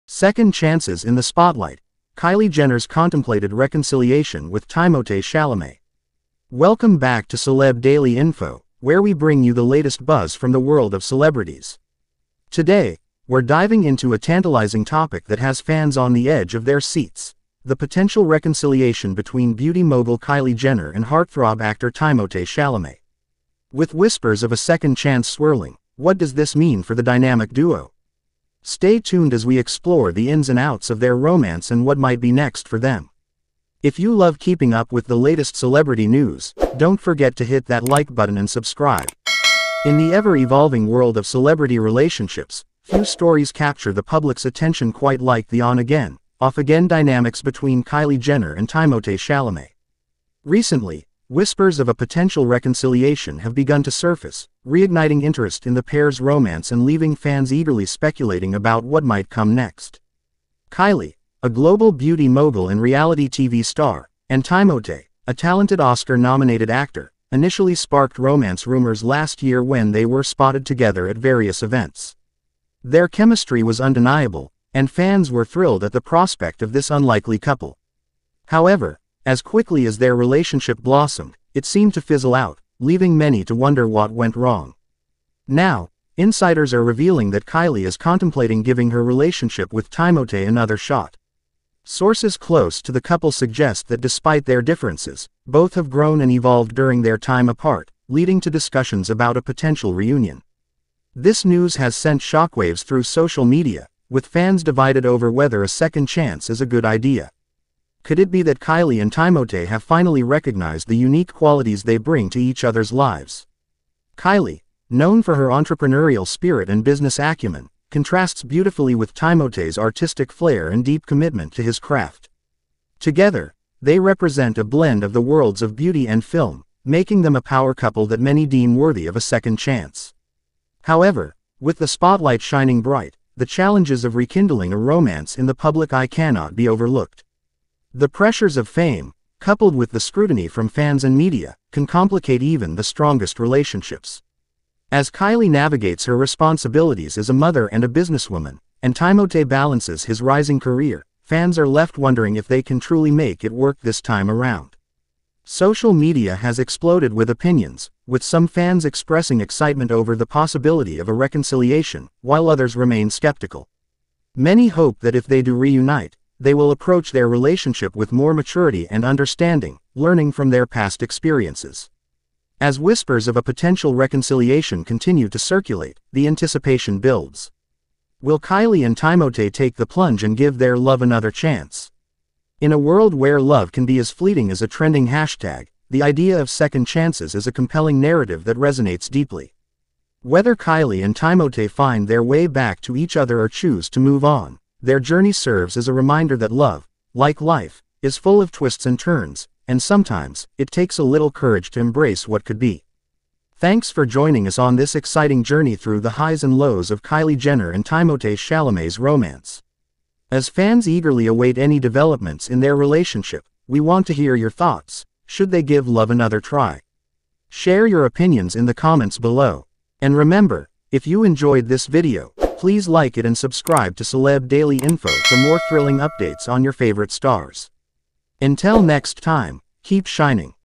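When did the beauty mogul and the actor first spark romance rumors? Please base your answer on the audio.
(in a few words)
last year.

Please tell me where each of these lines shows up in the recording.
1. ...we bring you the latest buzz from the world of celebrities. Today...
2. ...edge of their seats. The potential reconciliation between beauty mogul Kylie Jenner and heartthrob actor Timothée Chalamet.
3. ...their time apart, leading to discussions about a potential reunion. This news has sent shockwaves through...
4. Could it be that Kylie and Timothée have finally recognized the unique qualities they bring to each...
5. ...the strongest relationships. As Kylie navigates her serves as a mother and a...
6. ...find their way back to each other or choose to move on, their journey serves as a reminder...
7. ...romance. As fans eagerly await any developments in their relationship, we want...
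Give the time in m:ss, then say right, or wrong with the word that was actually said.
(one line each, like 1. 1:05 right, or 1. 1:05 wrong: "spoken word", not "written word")
1. 0:09 right
2. 0:16 right
3. 1:37 right
4. 1:48 right
5. 2:22 wrong: "responsibilities", not "serves"
6. 3:11 right
7. 3:28 right.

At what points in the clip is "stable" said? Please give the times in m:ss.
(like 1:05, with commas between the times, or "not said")
not said.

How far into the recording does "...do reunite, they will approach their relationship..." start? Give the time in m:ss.
2:45.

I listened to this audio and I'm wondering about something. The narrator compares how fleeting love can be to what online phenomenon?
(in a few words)
a trending hashtag.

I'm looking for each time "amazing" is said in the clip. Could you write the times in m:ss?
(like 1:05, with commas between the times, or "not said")
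not said.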